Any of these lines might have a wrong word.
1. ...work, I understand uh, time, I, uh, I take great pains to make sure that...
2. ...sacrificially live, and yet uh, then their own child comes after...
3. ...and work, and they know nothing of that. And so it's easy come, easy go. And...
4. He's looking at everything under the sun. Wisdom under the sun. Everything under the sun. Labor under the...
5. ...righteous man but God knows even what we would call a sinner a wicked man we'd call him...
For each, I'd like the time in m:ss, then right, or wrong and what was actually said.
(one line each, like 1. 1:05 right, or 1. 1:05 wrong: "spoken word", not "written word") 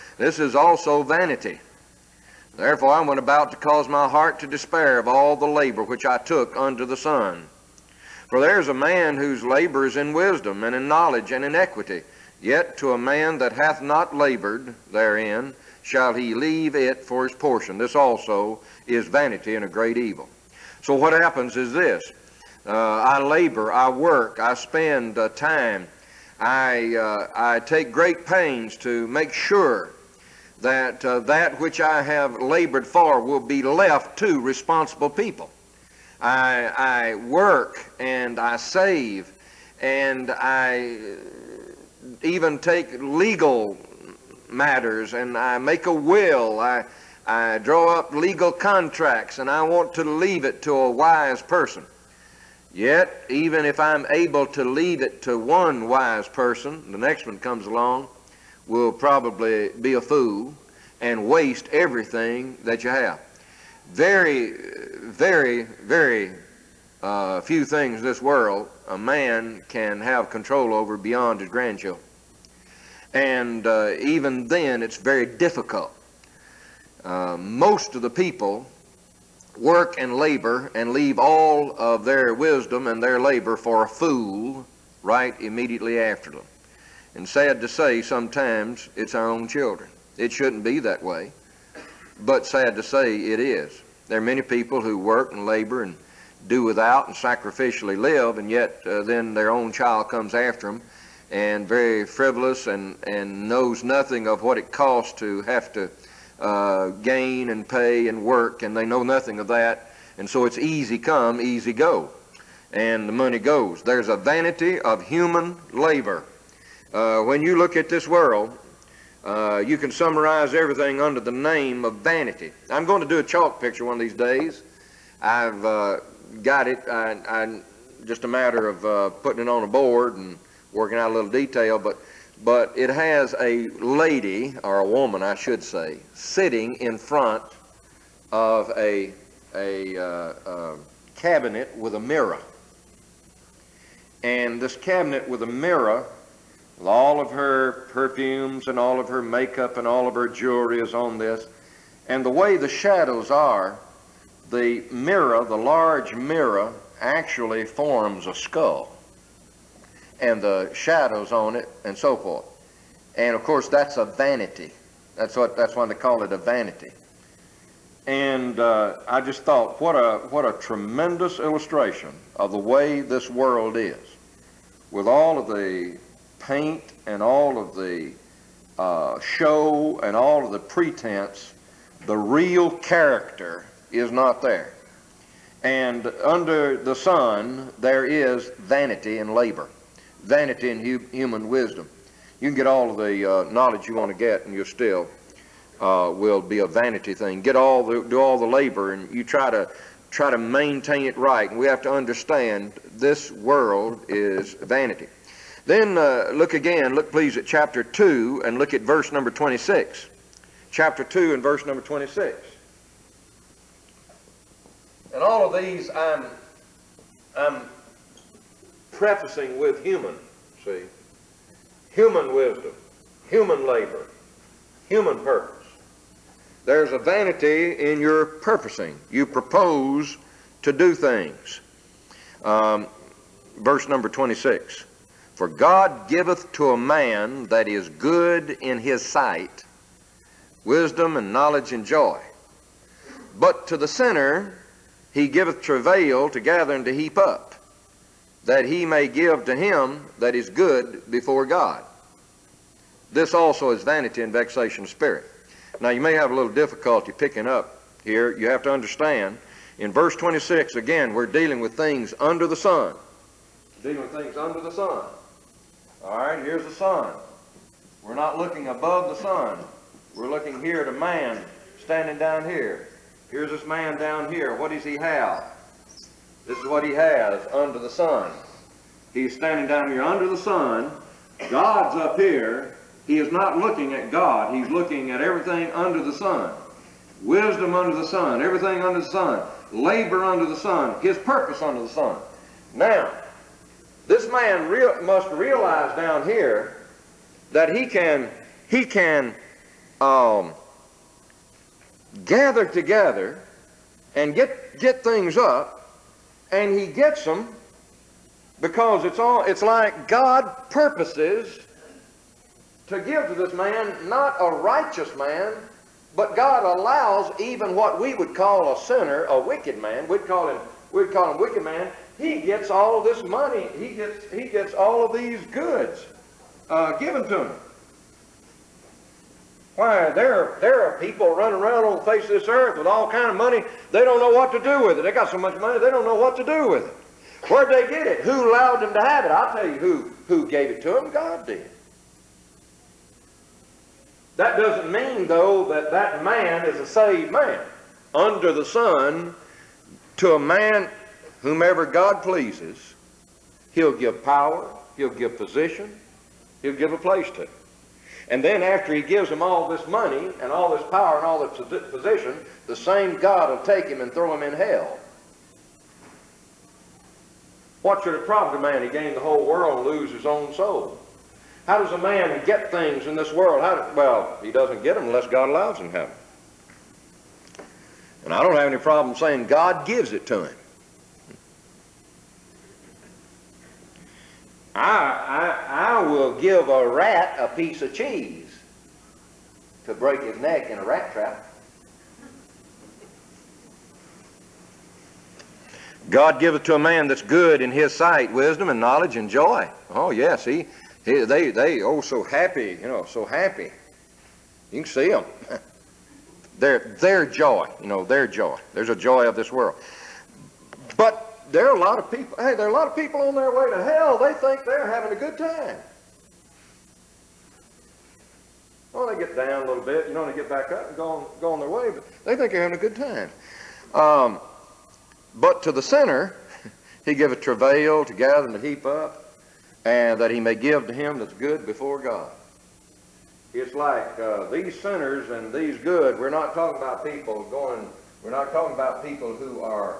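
1. 0:23 wrong: "spend", not "understand"
2. 1:37 right
3. 1:48 right
4. 4:44 right
5. 5:14 wrong: "allows", not "knows".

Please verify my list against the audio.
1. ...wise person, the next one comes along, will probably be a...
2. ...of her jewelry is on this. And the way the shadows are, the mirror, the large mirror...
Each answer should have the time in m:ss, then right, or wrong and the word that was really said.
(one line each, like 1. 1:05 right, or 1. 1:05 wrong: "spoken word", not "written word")
1. 0:55 right
2. 2:30 right.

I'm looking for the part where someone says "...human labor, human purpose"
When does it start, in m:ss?
3:43.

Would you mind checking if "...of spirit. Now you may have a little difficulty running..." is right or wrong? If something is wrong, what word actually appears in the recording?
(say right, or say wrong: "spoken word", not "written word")
wrong: "picking", not "running".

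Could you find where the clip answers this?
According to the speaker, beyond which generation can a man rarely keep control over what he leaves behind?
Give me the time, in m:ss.
1:11.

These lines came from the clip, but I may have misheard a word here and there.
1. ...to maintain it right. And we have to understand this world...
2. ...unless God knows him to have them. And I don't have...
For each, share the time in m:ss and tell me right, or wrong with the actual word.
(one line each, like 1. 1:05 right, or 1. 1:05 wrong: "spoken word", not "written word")
1. 3:20 right
2. 6:15 wrong: "allows", not "knows".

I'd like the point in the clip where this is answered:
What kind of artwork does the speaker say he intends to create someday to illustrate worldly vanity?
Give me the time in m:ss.
2:03.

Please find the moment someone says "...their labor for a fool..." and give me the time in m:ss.
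1:23.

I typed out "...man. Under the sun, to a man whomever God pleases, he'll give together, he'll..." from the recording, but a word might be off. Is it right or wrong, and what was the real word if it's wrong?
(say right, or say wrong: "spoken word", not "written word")
wrong: "power", not "together".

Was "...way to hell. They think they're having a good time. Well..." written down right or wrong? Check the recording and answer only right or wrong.
right.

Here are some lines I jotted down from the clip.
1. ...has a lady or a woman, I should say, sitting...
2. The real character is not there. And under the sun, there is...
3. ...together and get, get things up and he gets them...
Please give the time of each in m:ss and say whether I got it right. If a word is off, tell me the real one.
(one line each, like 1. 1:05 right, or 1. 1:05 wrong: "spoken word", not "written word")
1. 2:12 right
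2. 3:02 right
3. 5:02 right.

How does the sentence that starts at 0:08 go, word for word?
For there is a man whose labor is in wisdom, and in knowledge, and in equity.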